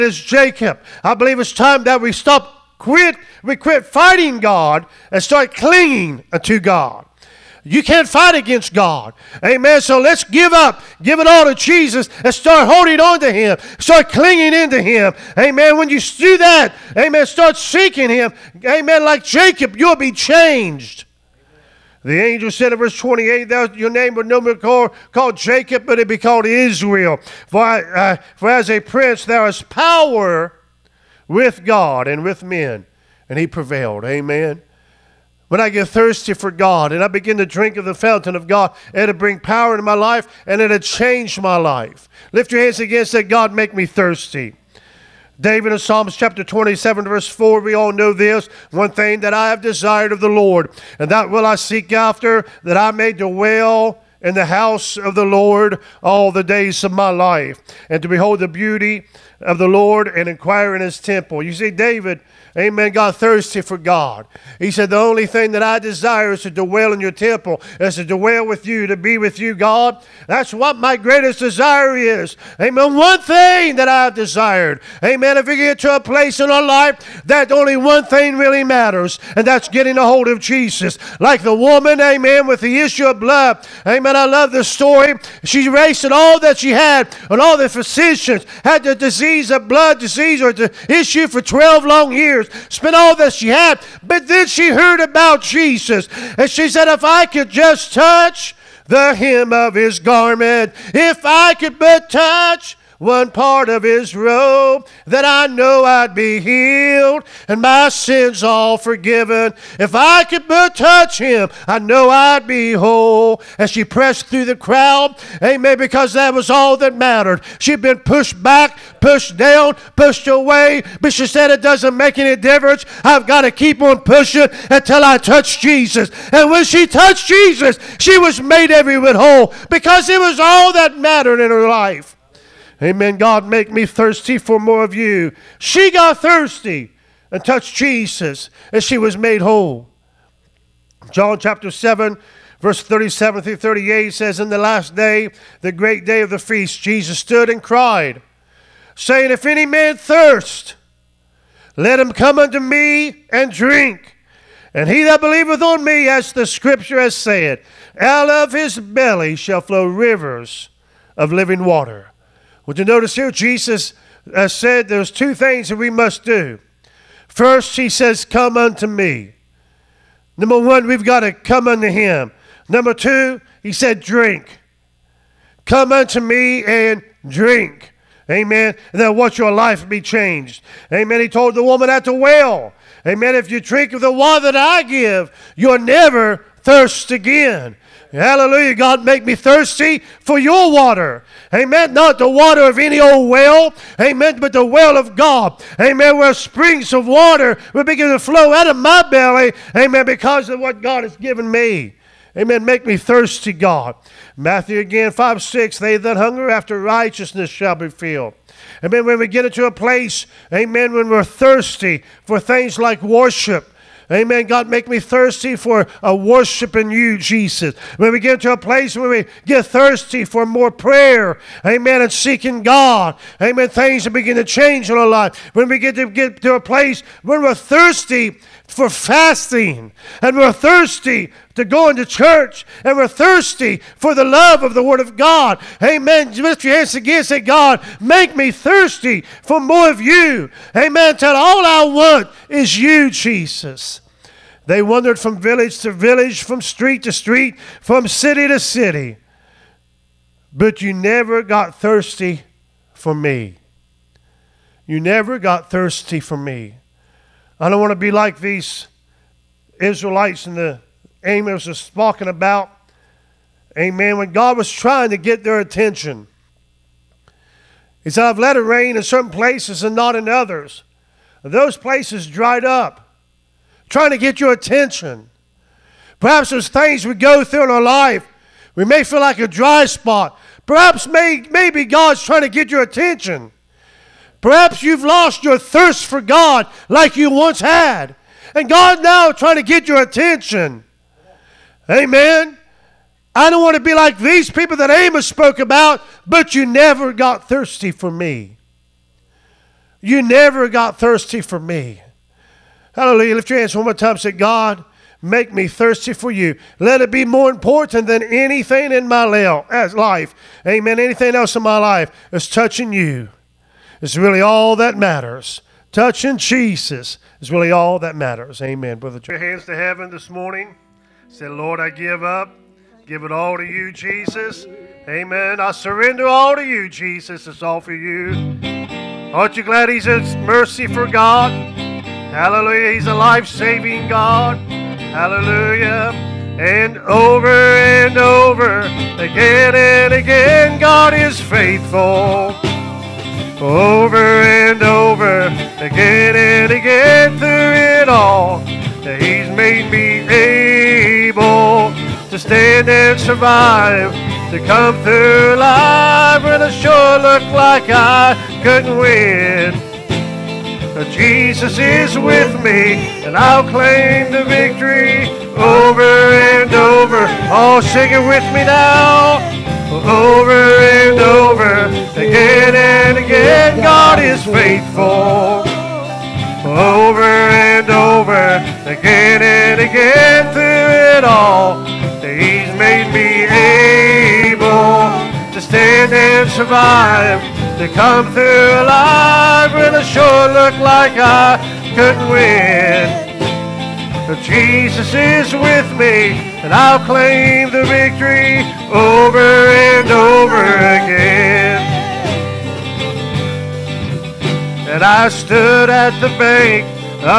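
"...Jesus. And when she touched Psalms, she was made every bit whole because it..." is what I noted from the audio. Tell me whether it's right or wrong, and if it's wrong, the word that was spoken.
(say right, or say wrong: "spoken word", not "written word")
wrong: "Jesus", not "Psalms".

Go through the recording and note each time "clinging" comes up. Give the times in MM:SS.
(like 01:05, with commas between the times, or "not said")
00:05, 00:14.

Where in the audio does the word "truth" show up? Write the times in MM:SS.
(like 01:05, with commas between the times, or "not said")
not said.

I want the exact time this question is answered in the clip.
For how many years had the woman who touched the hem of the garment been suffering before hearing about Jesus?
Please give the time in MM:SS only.
01:31.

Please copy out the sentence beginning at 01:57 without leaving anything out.
She'd been pushed back, pushed down, pushed away, but she said, It doesn't make any difference.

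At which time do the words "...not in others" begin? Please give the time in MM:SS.
04:29.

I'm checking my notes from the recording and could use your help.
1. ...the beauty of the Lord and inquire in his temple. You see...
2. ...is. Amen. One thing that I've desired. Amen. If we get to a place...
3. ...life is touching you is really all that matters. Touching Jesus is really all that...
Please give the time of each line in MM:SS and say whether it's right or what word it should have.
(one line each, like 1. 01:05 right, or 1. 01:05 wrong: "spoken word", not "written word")
1. 00:58 right
2. 01:11 right
3. 05:11 right.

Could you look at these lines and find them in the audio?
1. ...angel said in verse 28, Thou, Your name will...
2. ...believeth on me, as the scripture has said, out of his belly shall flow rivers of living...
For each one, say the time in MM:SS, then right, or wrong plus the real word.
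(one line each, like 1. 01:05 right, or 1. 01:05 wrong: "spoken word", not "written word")
1. 00:22 right
2. 02:35 right.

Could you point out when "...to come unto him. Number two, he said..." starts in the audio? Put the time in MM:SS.
02:51.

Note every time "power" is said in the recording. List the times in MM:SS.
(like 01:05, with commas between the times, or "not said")
00:29, 00:39.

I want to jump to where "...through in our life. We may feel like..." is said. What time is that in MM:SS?
04:37.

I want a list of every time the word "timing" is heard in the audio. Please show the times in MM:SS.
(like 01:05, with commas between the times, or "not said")
not said.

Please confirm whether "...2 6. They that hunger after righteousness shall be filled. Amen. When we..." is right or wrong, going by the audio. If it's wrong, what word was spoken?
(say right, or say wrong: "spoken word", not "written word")
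wrong: "5", not "2".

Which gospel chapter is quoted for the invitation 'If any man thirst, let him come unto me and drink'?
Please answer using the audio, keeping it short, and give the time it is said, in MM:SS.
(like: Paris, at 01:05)
John chapter 7, at 02:21.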